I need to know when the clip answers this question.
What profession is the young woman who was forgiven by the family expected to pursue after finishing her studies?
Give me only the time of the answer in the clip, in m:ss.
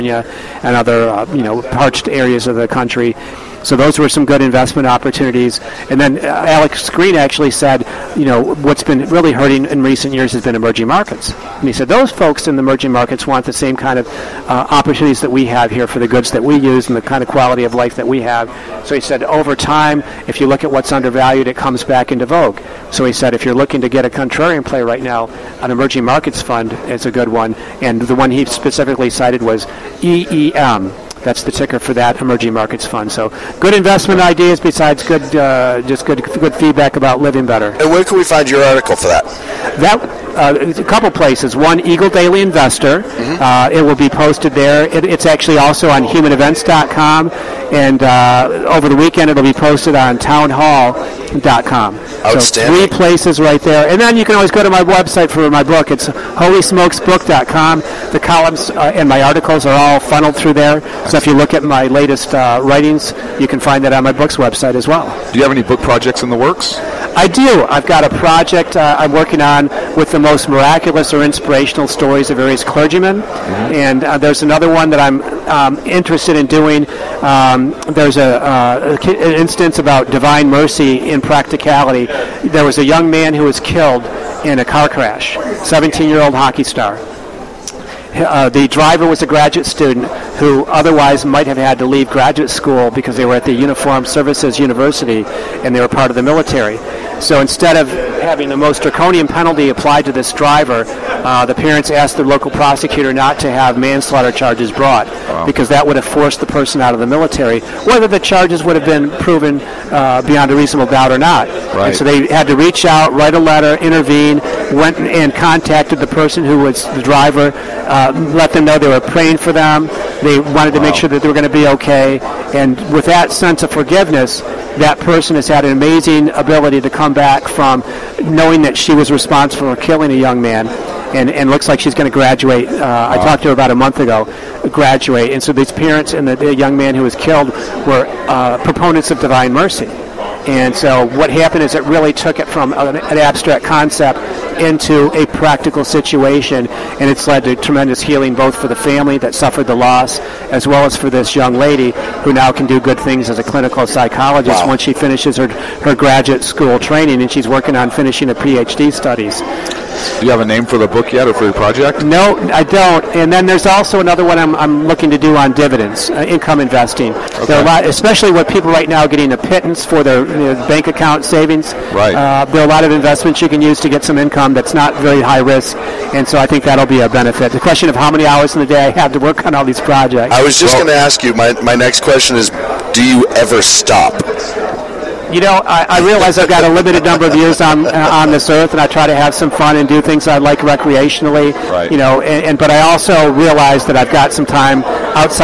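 2:33.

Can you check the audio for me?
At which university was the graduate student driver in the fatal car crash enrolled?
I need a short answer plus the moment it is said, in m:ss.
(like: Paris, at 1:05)
Uniform Services University, at 1:33.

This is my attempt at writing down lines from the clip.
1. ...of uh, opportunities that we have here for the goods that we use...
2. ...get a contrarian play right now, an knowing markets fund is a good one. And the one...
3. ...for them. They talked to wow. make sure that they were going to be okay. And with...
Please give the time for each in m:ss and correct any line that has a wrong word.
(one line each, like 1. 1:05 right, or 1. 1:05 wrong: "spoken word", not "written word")
1. 0:13 right
2. 0:23 wrong: "emerging", not "knowing"
3. 1:59 wrong: "wanted", not "talked".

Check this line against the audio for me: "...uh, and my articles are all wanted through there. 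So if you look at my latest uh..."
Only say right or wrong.
wrong.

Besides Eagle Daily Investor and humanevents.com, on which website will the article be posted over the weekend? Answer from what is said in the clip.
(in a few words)
townhall.com.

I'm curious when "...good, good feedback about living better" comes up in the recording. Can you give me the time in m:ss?
0:36.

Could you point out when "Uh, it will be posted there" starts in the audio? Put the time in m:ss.
0:43.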